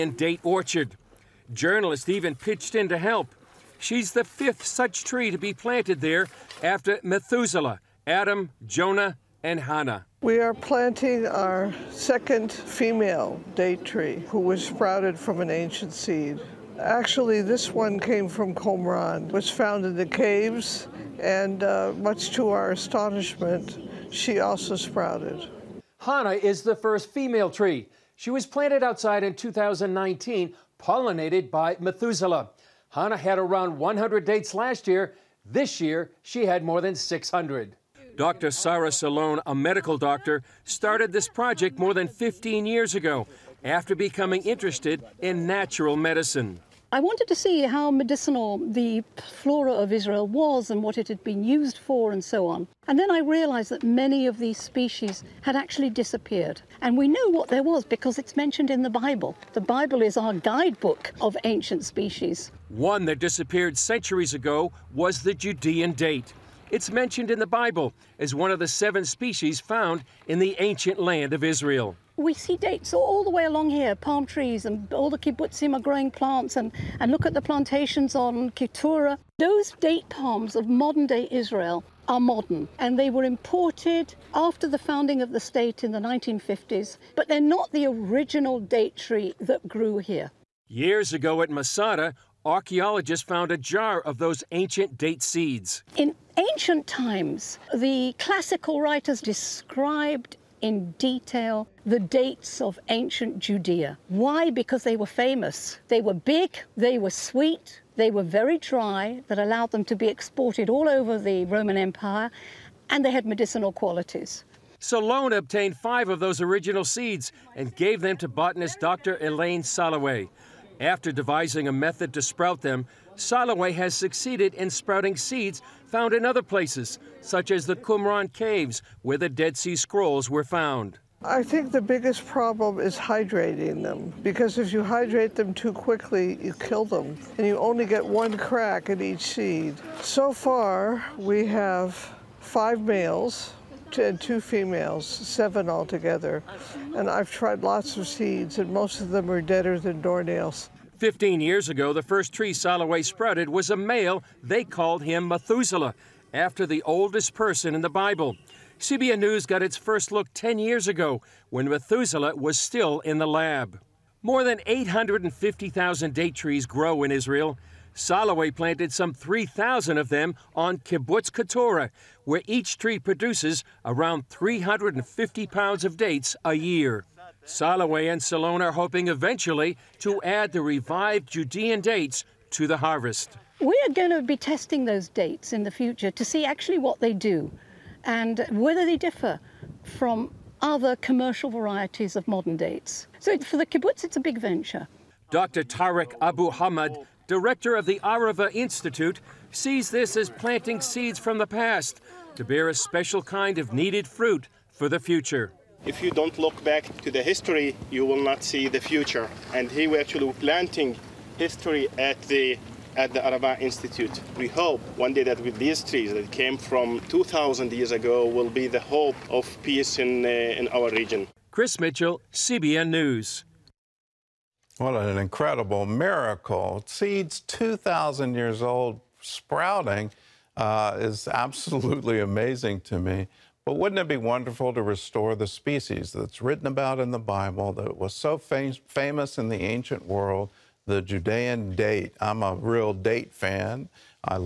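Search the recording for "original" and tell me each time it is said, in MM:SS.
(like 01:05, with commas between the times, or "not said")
01:27, 01:56.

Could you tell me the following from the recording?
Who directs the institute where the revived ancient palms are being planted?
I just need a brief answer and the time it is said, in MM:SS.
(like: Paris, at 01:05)
Dr. Tarek Abu Hamad, at 03:15.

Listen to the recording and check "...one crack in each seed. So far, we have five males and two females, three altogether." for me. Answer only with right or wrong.
wrong.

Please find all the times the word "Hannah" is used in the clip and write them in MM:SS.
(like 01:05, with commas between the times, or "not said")
00:09, 00:26, 00:32.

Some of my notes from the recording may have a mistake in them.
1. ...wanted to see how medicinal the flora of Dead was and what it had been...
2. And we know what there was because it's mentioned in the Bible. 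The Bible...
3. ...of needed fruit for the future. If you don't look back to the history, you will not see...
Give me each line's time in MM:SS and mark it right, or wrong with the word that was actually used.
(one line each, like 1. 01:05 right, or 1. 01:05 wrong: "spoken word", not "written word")
1. 00:47 wrong: "Israel", not "Dead"
2. 00:56 right
3. 03:23 right.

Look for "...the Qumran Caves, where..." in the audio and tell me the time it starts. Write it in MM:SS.
02:07.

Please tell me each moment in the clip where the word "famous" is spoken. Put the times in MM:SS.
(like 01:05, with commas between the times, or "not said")
01:45, 03:58.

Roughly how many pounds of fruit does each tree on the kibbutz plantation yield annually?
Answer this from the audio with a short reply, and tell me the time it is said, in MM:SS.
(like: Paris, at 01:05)
350, at 02:54.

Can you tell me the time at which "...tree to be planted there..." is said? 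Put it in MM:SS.
00:05.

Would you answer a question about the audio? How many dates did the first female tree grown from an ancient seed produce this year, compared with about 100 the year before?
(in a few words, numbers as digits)
more than 600.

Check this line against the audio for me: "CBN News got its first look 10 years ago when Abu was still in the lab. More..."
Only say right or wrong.
wrong.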